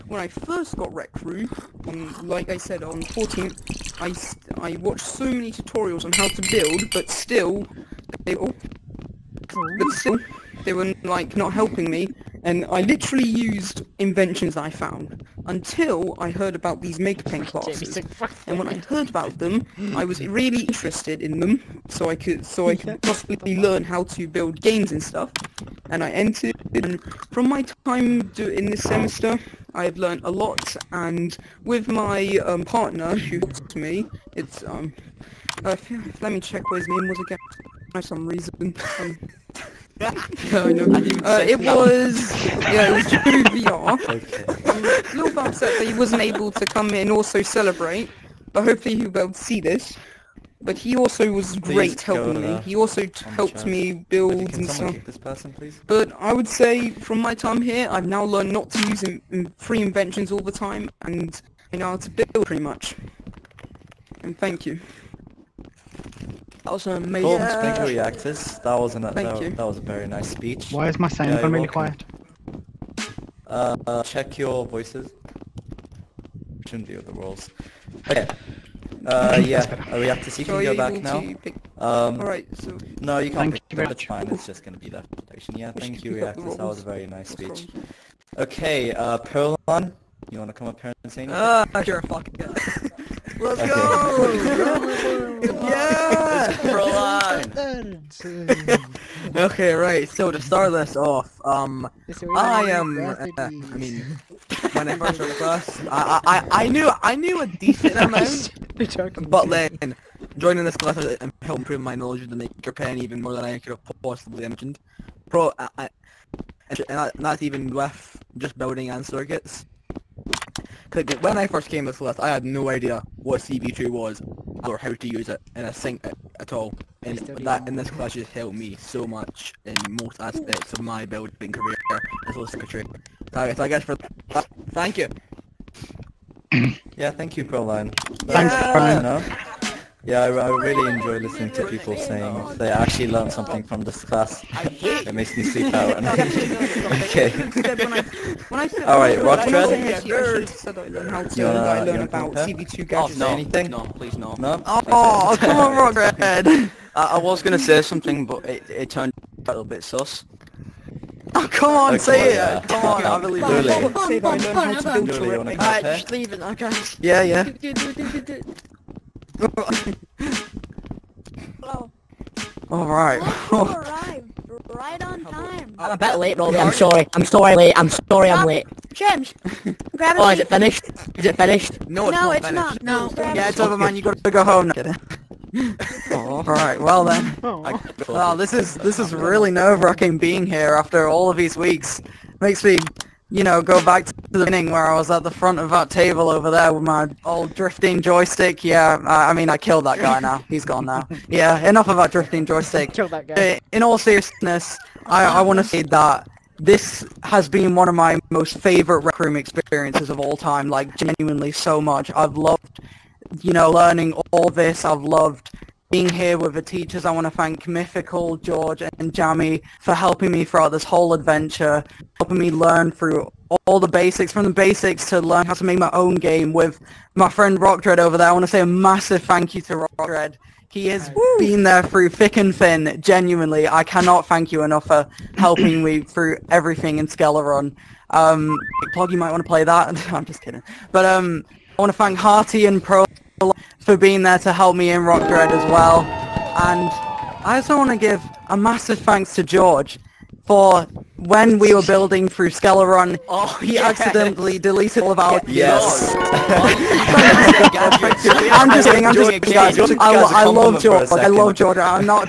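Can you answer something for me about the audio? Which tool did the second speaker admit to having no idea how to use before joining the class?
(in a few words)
CV2.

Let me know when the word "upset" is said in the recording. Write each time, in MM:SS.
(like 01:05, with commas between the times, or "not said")
00:45.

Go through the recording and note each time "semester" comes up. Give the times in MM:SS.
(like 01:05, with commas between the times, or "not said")
00:28.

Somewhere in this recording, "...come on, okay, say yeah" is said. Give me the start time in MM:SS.
02:41.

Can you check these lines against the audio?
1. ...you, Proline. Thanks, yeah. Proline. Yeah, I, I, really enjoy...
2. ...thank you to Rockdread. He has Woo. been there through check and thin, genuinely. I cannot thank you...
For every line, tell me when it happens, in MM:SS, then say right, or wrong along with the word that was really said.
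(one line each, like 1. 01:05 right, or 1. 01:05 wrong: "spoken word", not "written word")
1. 02:17 right
2. 03:49 wrong: "thick", not "check".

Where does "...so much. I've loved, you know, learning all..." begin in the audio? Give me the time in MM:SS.
03:31.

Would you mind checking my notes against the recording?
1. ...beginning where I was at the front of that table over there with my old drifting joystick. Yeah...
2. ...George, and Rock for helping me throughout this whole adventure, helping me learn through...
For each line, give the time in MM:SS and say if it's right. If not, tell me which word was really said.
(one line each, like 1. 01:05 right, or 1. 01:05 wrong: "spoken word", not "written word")
1. 03:14 right
2. 03:38 wrong: "Jammy", not "Rock".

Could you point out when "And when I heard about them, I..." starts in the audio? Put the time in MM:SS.
00:18.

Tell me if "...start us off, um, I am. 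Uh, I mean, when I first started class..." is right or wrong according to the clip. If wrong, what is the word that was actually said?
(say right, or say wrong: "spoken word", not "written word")
right.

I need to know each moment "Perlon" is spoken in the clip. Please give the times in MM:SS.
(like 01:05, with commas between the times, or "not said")
01:29.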